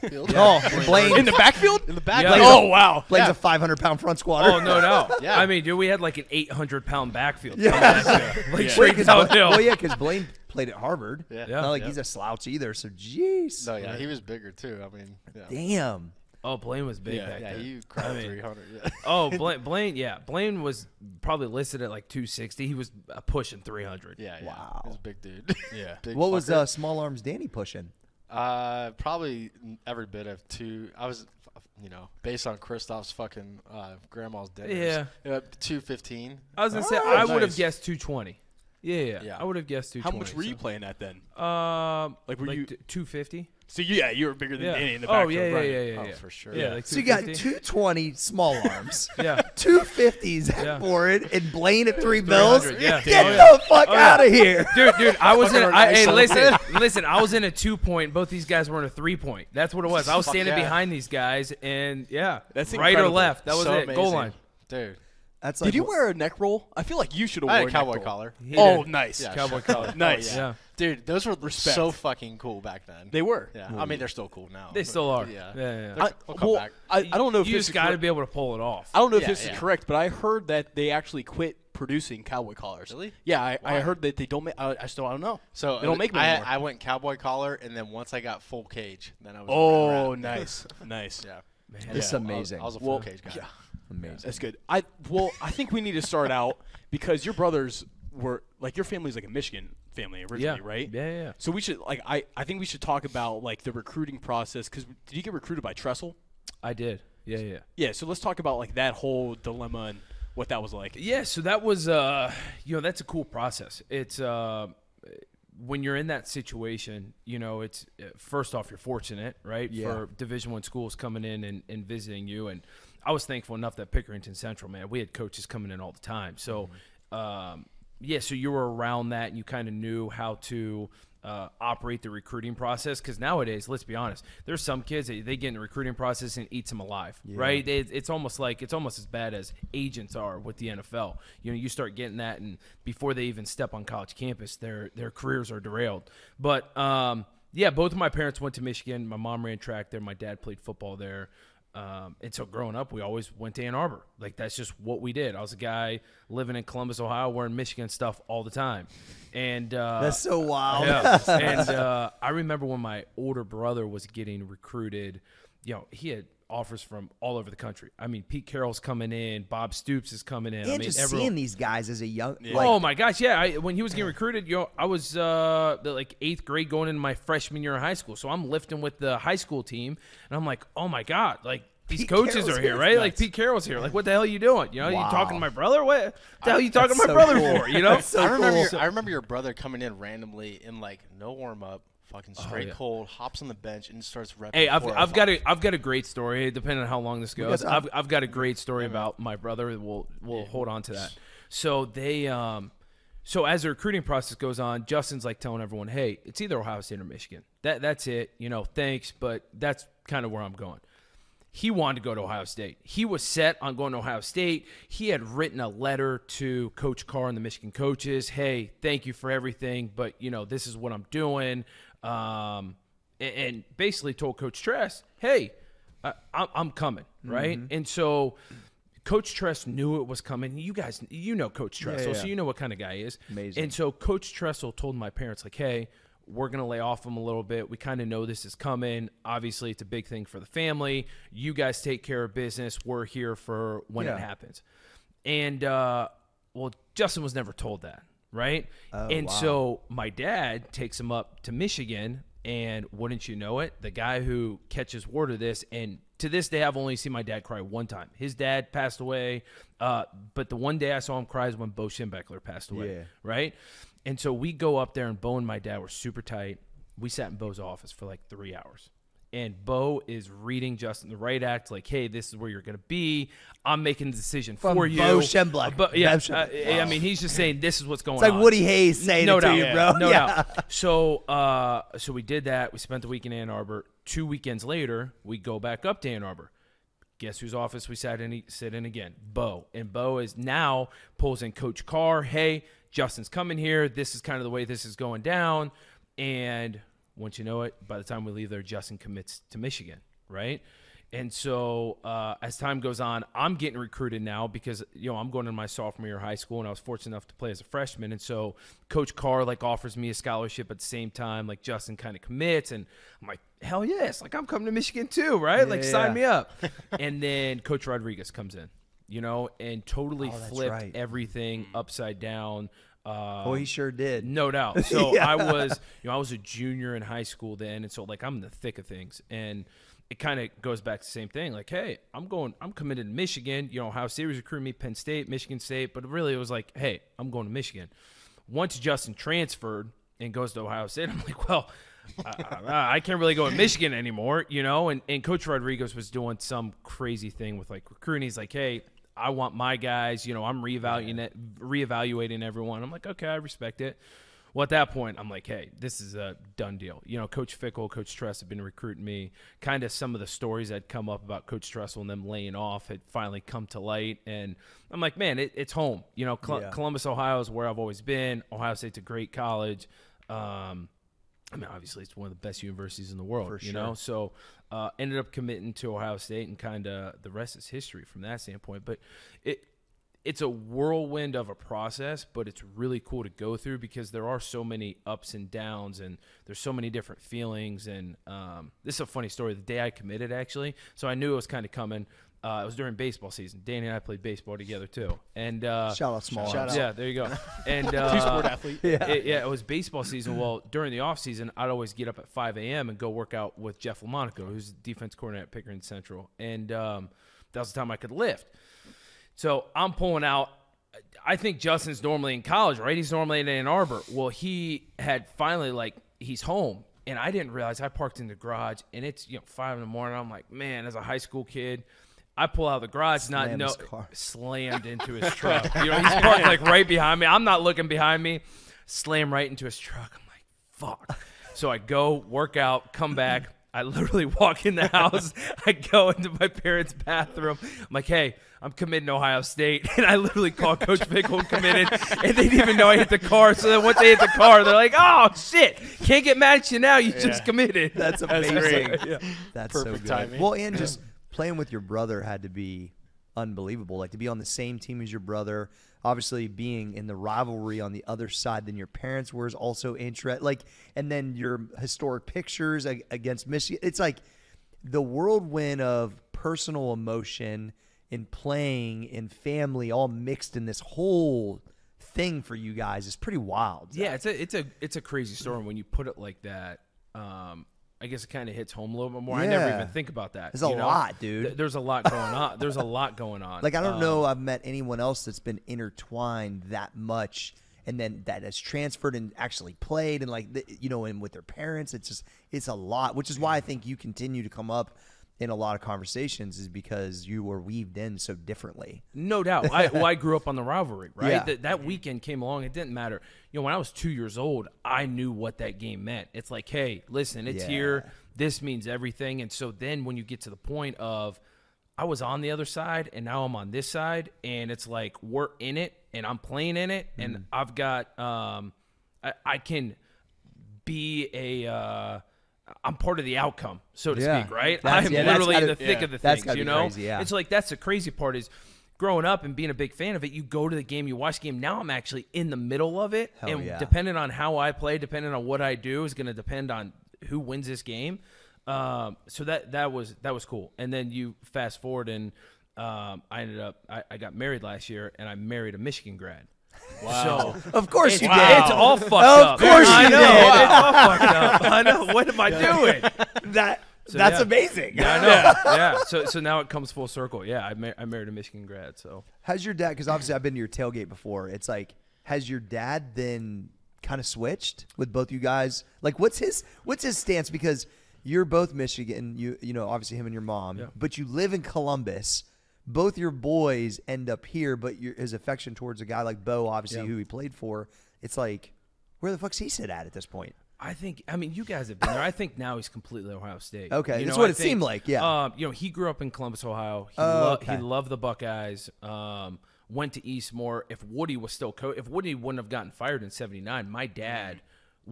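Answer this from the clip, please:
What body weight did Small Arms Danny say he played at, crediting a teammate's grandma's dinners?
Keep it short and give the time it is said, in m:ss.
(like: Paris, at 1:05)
215, at 0:35.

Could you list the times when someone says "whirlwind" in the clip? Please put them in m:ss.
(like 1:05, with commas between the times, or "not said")
6:20, 7:45.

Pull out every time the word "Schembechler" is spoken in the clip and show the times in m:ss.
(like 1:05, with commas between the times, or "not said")
4:21, 4:35.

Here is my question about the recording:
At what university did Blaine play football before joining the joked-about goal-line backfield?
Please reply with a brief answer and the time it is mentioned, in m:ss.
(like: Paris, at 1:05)
Harvard, at 0:10.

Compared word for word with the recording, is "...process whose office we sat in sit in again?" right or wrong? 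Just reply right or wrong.
wrong.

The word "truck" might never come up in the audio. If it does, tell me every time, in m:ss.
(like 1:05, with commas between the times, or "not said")
7:05, 7:09.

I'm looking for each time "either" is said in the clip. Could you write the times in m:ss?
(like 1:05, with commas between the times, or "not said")
0:12, 3:26.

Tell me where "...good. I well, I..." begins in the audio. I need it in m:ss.
1:34.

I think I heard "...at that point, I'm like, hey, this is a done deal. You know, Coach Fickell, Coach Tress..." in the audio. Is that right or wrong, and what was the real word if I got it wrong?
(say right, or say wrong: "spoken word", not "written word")
right.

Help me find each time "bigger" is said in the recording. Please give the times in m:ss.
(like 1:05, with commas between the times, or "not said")
0:14, 0:44.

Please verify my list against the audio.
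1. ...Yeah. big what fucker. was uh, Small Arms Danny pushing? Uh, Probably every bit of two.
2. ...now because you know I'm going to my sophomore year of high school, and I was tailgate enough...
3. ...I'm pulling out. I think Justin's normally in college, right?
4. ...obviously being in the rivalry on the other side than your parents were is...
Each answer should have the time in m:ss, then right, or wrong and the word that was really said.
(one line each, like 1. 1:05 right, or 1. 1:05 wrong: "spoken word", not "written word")
1. 0:25 right
2. 5:04 wrong: "fortunate", not "tailgate"
3. 6:49 right
4. 7:36 right.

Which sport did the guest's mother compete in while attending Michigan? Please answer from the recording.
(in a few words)
Track.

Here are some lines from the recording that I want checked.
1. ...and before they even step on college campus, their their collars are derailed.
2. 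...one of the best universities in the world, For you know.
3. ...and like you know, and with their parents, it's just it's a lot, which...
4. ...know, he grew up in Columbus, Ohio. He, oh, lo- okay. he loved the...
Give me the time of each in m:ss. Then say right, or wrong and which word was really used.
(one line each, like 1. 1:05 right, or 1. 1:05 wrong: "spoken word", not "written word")
1. 2:22 wrong: "careers", not "collars"
2. 6:12 right
3. 8:10 right
4. 9:45 right.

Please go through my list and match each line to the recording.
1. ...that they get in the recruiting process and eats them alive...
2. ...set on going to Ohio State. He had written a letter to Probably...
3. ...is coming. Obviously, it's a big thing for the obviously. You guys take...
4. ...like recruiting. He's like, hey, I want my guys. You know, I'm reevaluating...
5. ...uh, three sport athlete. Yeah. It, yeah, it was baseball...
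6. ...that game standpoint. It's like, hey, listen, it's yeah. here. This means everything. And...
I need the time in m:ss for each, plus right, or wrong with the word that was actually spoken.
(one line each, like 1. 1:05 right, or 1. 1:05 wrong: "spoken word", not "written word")
1. 2:15 right
2. 3:33 wrong: "Coach", not "Probably"
3. 3:58 wrong: "family", not "obviously"
4. 5:47 right
5. 6:37 wrong: "two", not "three"
6. 8:25 wrong: "meant", not "standpoint".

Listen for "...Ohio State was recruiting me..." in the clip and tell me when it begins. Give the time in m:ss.
5:33.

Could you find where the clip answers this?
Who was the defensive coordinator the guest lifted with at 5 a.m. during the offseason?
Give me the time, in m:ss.
6:43.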